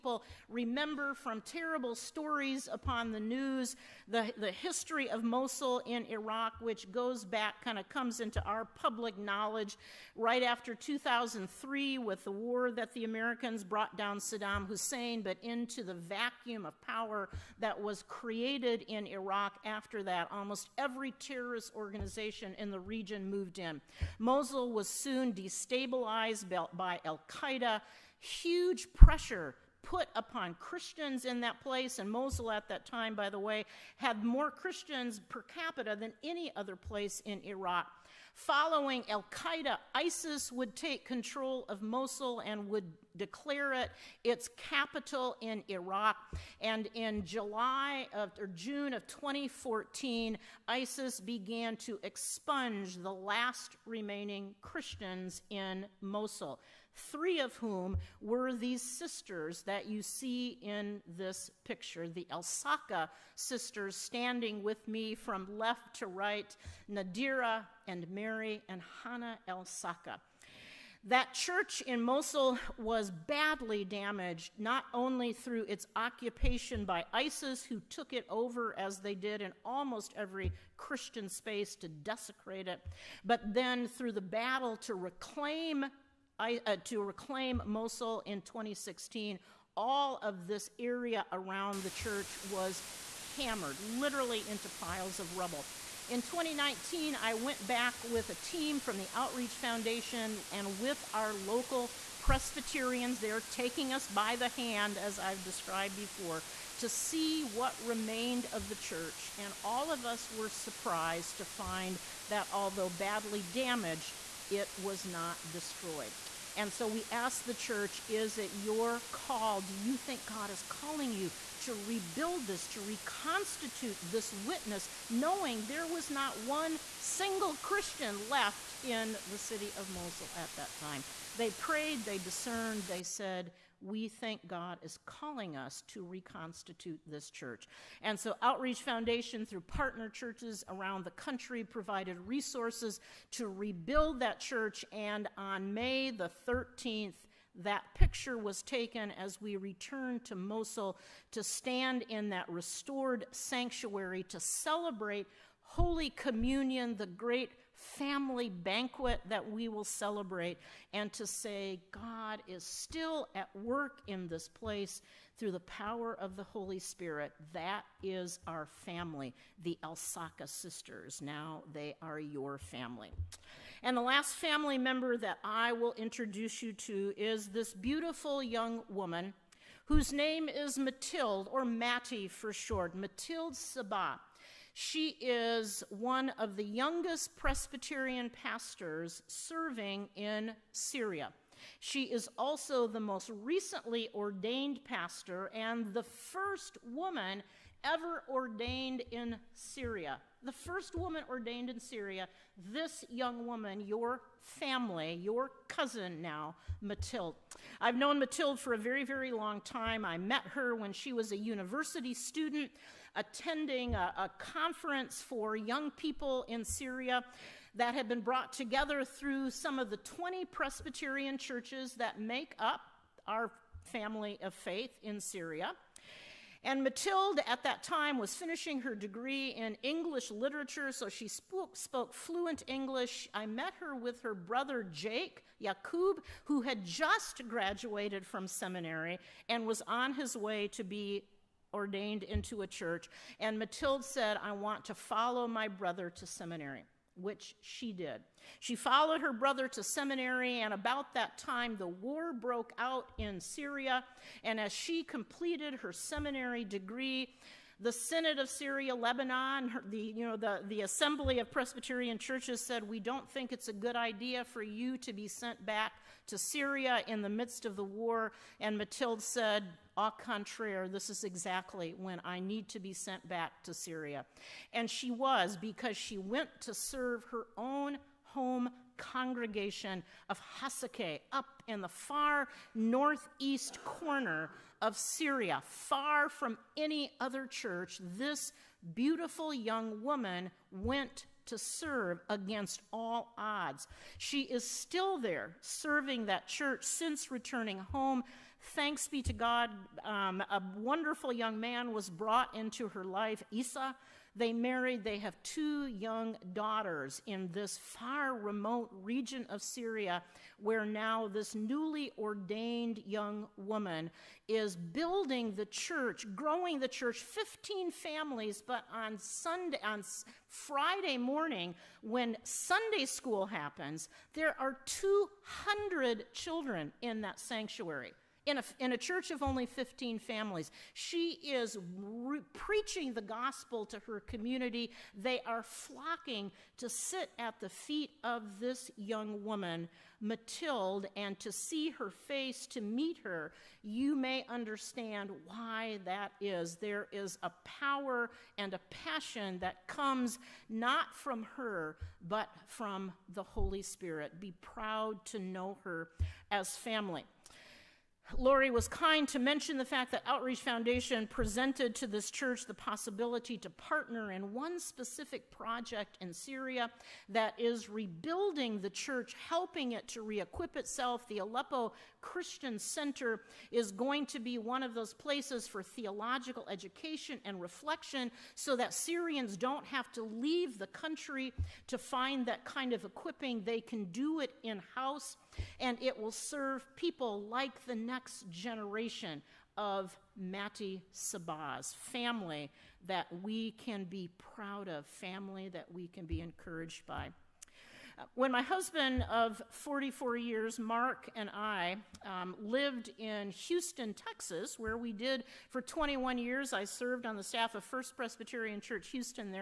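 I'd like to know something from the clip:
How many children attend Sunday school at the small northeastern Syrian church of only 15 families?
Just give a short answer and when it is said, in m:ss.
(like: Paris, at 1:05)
200, at 5:24.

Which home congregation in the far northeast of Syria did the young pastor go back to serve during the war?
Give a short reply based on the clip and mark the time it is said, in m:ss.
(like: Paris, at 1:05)
Hasake, at 4:40.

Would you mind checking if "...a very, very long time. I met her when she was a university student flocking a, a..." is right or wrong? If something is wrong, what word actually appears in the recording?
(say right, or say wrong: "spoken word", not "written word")
wrong: "attending", not "flocking".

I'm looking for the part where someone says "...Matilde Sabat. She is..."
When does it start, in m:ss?
3:02.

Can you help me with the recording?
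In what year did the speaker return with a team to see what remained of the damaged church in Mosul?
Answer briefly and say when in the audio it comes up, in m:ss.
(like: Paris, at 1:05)
2019, at 1:36.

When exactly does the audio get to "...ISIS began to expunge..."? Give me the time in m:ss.
0:50.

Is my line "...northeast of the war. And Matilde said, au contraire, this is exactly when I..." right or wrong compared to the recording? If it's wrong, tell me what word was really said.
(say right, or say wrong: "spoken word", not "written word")
wrong: "midst", not "northeast".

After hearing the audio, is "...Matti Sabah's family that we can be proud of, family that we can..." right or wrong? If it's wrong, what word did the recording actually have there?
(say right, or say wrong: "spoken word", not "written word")
right.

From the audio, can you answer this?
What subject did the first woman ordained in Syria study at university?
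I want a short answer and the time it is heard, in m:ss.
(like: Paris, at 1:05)
English literature, at 3:49.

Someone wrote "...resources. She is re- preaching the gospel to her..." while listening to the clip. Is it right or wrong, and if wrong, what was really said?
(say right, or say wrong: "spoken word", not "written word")
wrong: "families", not "resources".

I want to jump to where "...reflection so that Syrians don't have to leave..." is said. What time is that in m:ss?
6:17.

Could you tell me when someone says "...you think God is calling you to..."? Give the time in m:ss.
1:59.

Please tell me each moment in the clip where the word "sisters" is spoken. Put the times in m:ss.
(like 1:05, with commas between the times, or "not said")
0:58, 1:03, 2:50.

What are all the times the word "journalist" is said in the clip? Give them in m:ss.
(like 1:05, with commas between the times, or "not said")
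not said.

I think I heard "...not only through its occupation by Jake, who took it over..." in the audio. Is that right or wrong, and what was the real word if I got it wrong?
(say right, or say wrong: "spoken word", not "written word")
wrong: "ISIS", not "Jake".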